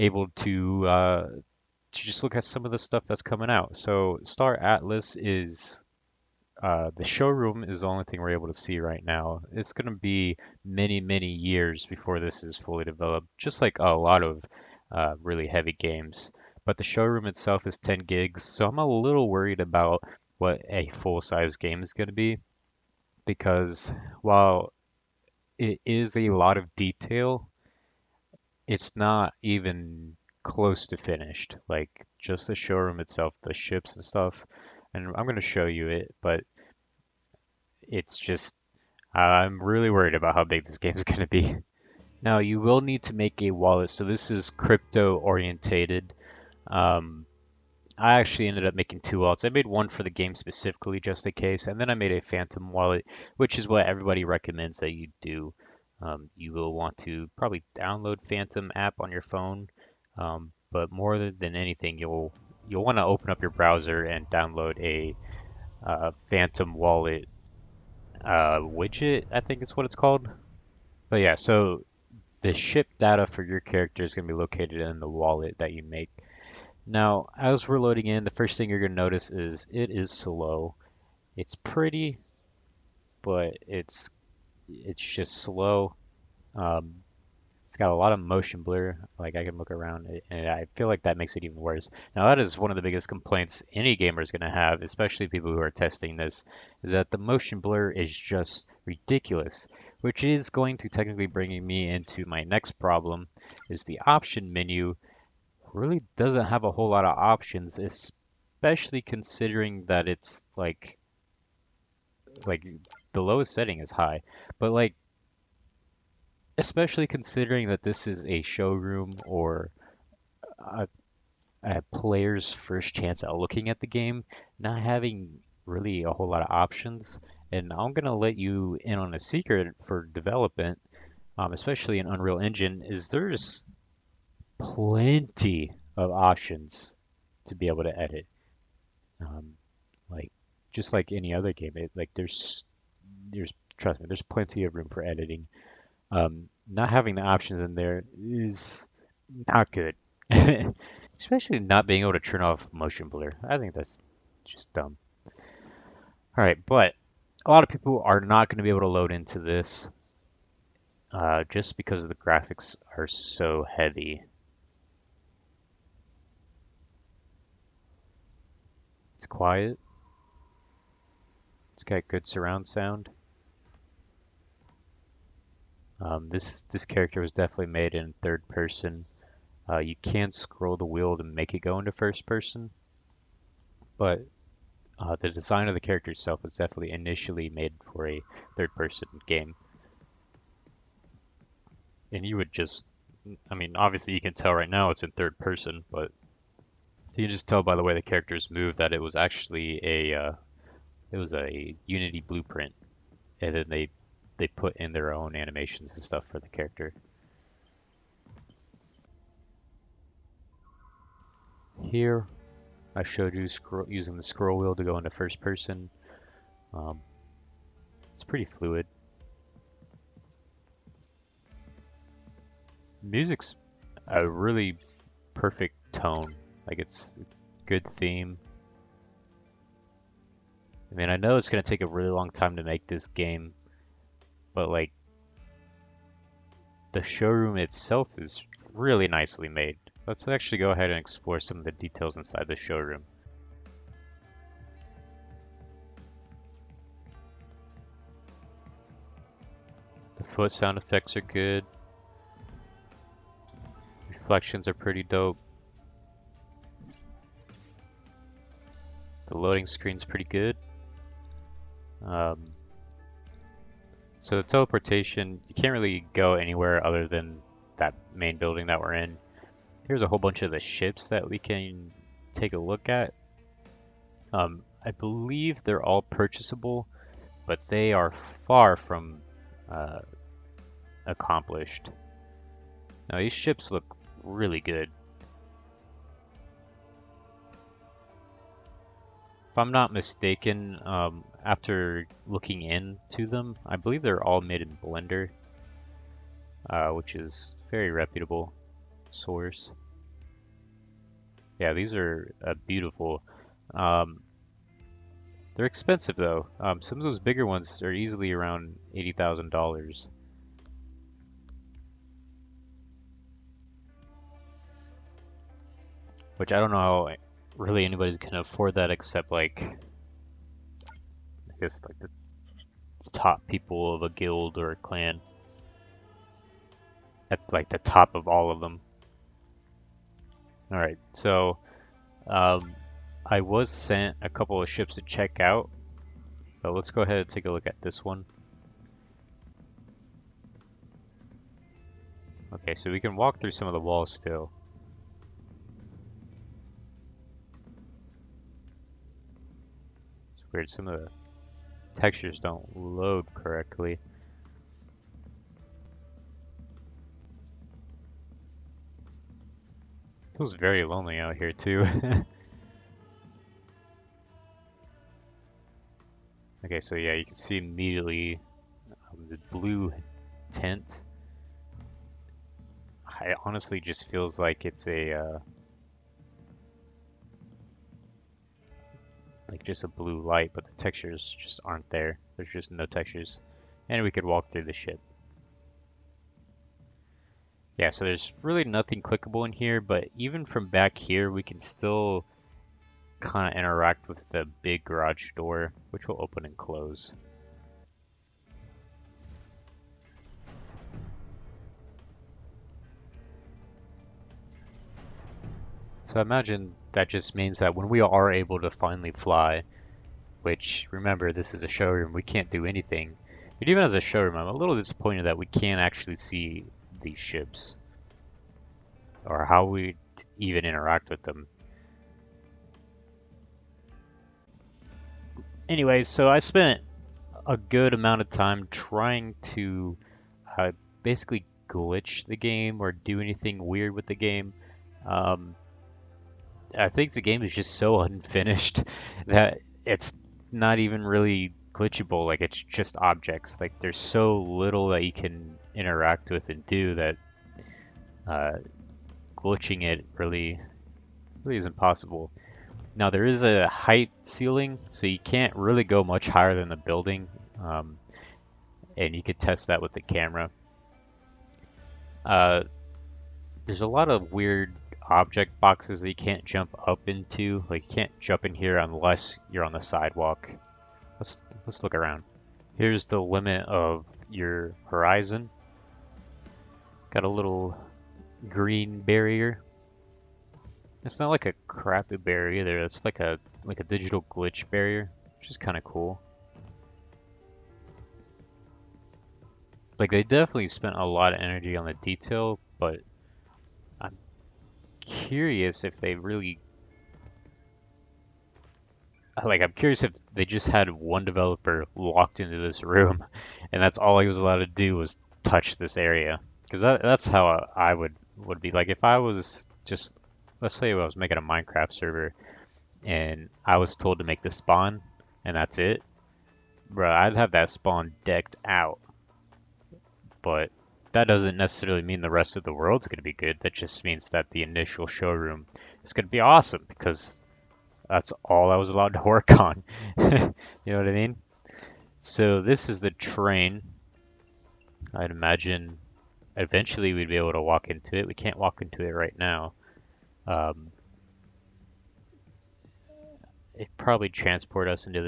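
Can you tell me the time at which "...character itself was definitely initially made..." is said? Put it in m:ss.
3:05.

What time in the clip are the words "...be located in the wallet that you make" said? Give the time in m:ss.
1:14.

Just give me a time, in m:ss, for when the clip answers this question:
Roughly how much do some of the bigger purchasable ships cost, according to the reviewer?
5:08.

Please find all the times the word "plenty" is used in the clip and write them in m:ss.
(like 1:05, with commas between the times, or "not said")
2:14, 2:24.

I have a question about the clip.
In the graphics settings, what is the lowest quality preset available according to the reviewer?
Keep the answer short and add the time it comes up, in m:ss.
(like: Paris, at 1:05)
High, at 1:53.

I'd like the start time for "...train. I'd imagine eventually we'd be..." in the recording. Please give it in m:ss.
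8:53.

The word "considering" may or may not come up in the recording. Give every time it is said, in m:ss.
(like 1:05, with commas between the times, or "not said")
1:49, 1:57.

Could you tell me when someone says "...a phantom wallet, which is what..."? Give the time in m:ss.
0:52.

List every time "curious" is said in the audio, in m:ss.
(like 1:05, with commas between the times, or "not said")
8:15, 8:19.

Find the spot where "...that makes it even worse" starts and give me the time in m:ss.
1:31.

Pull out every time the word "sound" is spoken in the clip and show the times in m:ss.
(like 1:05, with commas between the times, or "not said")
2:52, 4:10.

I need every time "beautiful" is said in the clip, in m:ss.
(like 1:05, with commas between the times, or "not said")
5:02.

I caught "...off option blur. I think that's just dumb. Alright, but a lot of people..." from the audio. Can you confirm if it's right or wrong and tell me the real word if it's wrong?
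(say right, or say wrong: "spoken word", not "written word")
wrong: "motion", not "option".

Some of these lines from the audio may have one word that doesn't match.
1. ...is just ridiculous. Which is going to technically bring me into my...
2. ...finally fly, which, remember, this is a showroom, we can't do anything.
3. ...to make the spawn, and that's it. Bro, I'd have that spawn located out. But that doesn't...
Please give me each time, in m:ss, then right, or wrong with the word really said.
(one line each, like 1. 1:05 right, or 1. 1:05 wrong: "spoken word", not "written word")
1. 1:37 right
2. 6:48 right
3. 8:34 wrong: "decked", not "located".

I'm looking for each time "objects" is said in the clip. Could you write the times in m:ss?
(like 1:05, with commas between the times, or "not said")
7:22, 7:45.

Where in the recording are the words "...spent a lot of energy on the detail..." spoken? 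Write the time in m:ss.
8:10.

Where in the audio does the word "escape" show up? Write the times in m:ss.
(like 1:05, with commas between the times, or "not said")
not said.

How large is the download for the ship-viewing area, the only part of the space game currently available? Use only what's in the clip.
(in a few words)
10 gigs.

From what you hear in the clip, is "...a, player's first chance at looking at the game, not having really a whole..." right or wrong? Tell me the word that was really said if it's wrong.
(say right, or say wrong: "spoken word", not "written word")
right.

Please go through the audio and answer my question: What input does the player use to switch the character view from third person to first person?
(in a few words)
Scroll wheel.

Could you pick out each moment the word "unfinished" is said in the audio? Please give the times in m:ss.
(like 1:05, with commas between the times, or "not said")
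7:18.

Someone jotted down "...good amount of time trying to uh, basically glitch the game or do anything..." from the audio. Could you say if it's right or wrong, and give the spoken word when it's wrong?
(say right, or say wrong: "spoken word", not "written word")
right.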